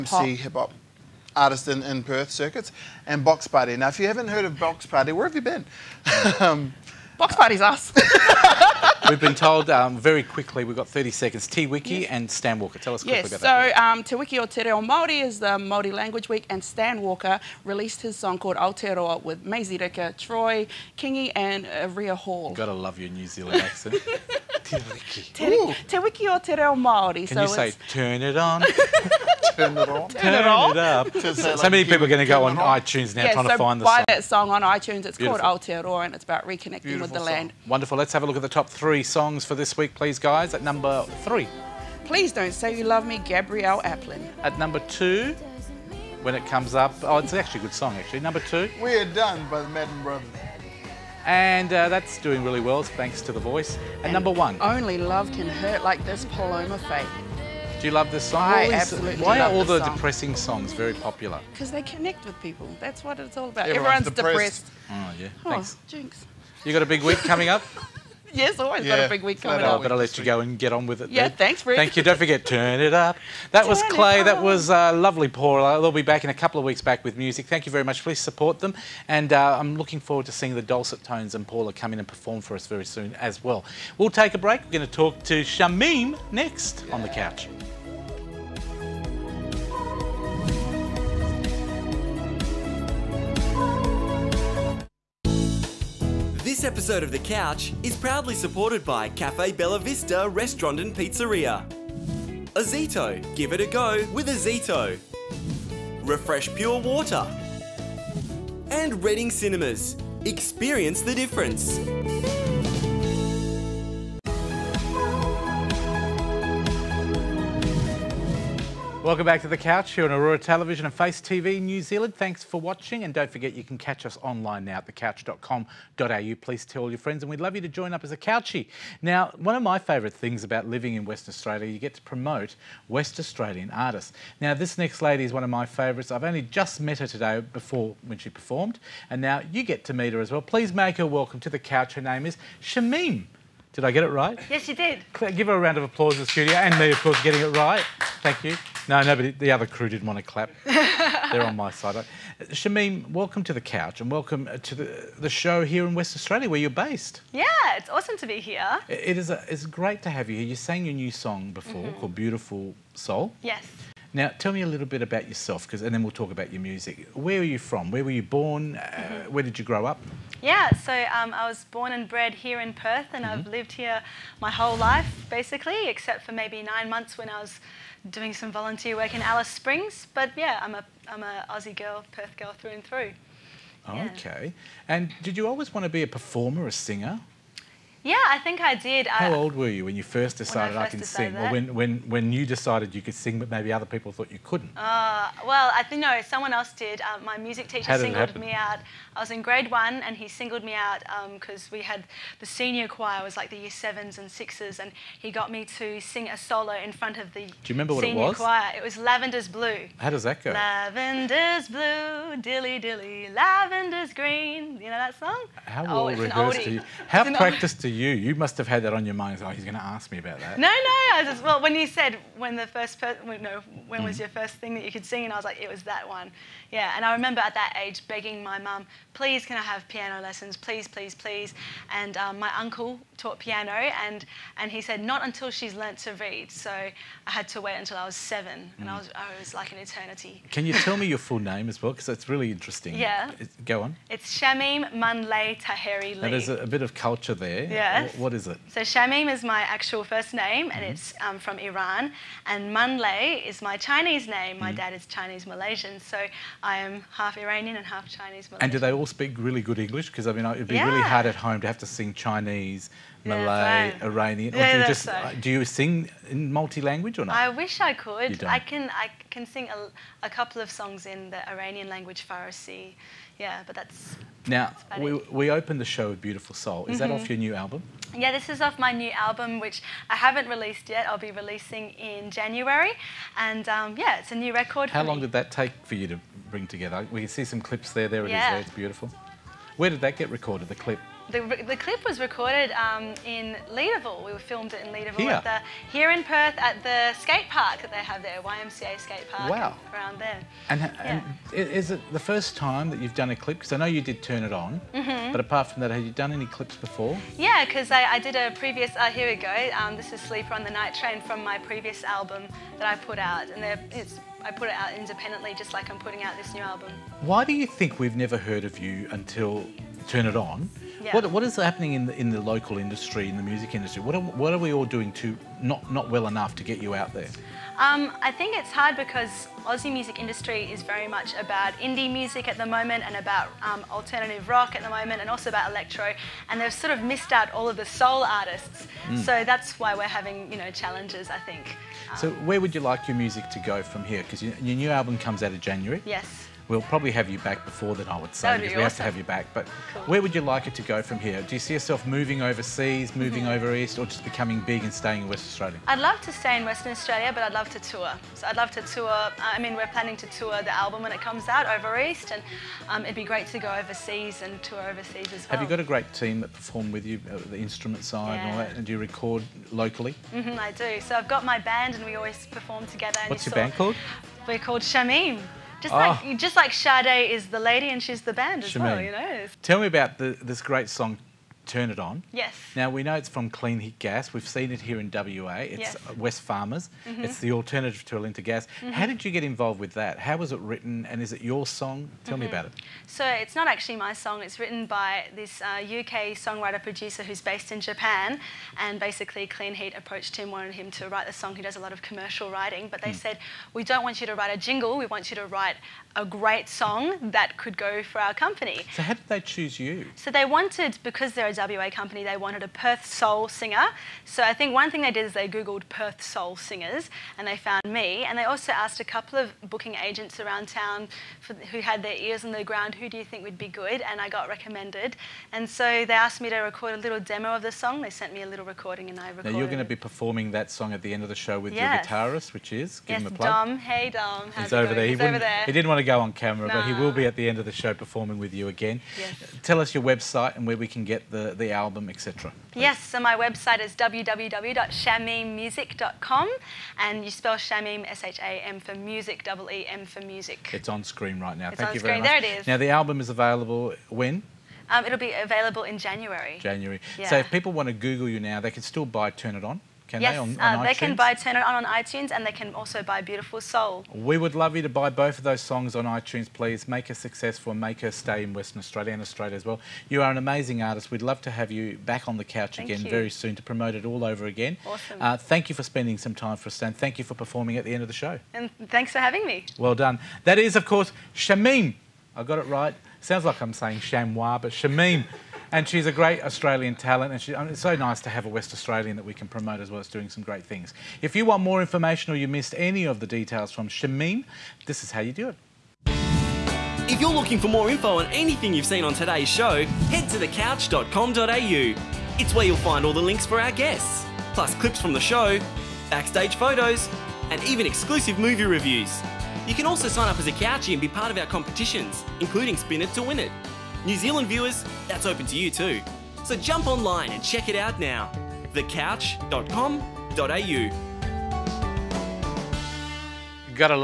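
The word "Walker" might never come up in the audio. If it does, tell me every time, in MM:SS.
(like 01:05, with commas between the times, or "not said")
00:12, 00:17.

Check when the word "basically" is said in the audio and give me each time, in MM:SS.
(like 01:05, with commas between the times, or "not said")
02:55, 06:39.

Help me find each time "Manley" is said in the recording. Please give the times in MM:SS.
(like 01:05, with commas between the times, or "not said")
04:04, 04:12.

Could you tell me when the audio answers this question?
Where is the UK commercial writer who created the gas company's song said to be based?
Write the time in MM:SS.
06:37.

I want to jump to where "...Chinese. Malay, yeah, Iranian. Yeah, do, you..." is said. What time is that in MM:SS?
04:22.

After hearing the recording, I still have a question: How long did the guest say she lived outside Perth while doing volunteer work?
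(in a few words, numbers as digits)
9 months.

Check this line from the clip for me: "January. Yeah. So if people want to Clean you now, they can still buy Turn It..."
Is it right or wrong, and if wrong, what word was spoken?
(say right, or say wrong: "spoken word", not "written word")
wrong: "Google", not "Clean".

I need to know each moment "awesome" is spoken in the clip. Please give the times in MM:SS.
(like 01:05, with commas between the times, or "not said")
02:37, 07:54.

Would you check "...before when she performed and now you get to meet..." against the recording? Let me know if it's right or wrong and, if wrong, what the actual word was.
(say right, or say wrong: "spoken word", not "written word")
right.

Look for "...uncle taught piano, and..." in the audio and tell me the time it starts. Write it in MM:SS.
03:52.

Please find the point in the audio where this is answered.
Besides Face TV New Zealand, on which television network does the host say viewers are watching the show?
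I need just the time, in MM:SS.
02:00.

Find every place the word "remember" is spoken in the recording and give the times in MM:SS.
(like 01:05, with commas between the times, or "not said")
03:27, 03:47.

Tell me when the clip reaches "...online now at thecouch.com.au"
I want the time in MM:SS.
02:04.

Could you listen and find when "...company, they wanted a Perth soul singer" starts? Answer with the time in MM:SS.
06:51.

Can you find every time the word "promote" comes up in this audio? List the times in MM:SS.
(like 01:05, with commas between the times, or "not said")
02:12, 07:53, 08:09.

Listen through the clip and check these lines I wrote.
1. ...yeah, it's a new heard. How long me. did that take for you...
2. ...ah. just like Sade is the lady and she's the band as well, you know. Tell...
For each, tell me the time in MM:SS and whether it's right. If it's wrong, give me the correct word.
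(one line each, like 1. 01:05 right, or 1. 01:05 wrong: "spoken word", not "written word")
1. 04:43 wrong: "record", not "heard"
2. 06:16 right.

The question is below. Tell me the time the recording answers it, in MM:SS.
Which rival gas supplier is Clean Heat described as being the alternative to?
06:28.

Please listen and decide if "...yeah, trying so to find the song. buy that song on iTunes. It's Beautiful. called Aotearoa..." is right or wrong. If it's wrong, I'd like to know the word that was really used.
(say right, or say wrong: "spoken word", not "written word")
right.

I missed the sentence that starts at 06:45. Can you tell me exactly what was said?
We want you to write a great song that could go for our company.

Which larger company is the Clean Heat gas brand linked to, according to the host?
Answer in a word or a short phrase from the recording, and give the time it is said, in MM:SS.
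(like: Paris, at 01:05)
Wesfarmers, at 06:26.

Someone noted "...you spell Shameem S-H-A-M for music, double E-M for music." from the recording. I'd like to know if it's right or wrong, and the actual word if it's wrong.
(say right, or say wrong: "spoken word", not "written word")
right.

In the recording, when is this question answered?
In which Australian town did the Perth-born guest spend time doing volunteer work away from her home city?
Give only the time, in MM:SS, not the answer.
02:59.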